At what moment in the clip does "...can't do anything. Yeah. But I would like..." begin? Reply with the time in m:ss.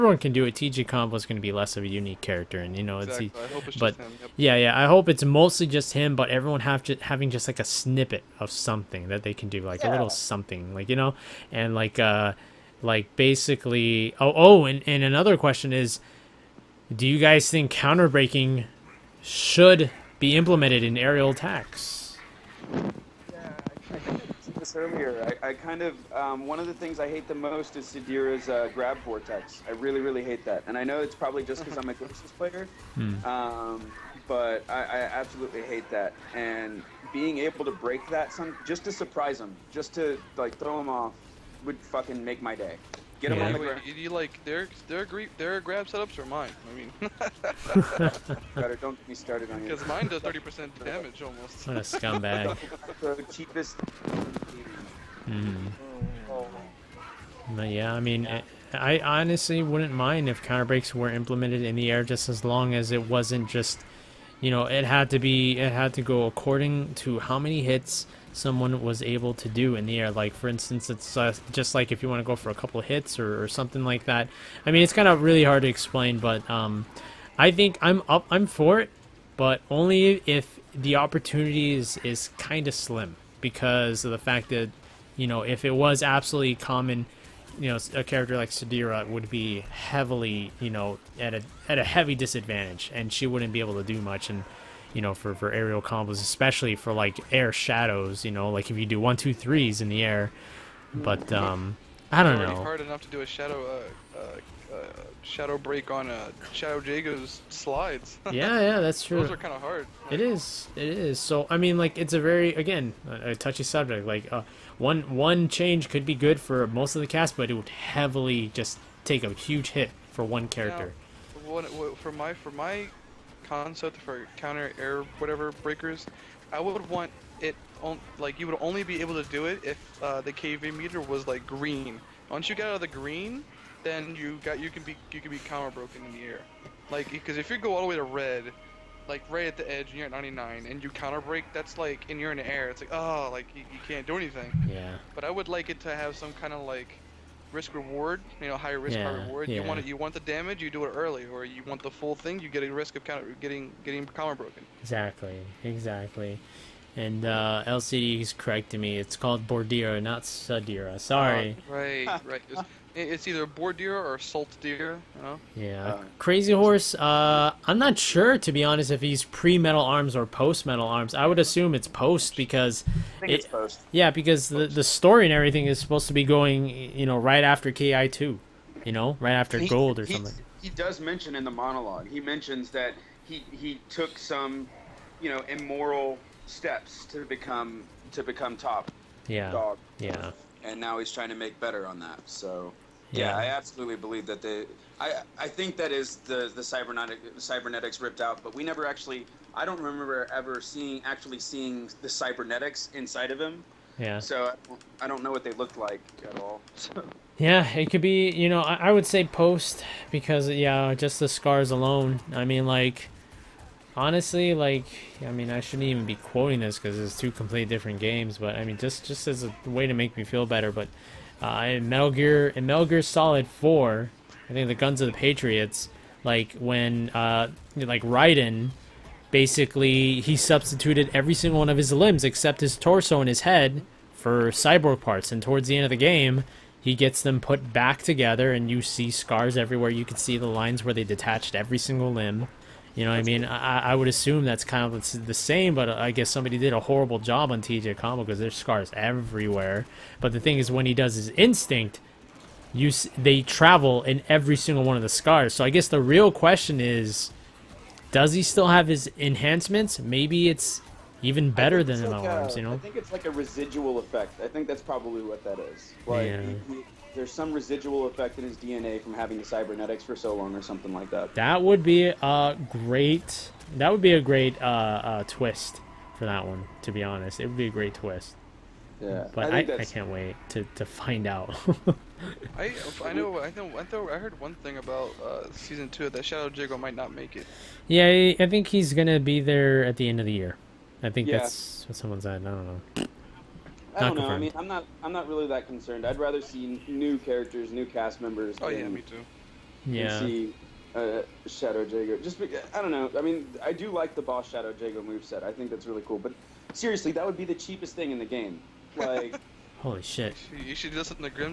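2:23.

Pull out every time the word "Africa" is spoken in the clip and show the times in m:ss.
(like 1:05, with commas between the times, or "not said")
not said.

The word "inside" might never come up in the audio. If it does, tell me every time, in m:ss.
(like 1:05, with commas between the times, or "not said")
3:22.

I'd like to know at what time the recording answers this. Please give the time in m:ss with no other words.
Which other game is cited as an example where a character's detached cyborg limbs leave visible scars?
3:42.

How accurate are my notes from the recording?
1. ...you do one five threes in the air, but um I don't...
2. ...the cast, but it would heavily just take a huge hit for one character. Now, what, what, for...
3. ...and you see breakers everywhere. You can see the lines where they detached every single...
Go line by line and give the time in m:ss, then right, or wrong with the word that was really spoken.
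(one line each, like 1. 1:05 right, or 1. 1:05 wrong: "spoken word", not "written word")
1. 1:38 wrong: "two", not "five"
2. 1:57 right
3. 3:58 wrong: "scars", not "breakers".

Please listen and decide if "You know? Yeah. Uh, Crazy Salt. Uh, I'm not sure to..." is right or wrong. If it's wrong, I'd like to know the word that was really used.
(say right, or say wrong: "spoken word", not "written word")
wrong: "Horse", not "Salt".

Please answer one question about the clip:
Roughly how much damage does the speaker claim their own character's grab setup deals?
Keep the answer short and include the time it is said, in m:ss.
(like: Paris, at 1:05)
30 percent, at 0:50.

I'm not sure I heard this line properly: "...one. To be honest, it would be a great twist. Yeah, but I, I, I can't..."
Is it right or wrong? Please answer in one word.
right.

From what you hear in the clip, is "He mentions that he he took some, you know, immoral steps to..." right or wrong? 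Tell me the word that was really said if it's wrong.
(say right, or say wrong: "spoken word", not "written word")
right.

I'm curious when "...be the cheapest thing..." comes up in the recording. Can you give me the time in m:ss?
5:07.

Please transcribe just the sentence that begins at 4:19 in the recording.
Maybe it's even better than like MLMs, a, you know.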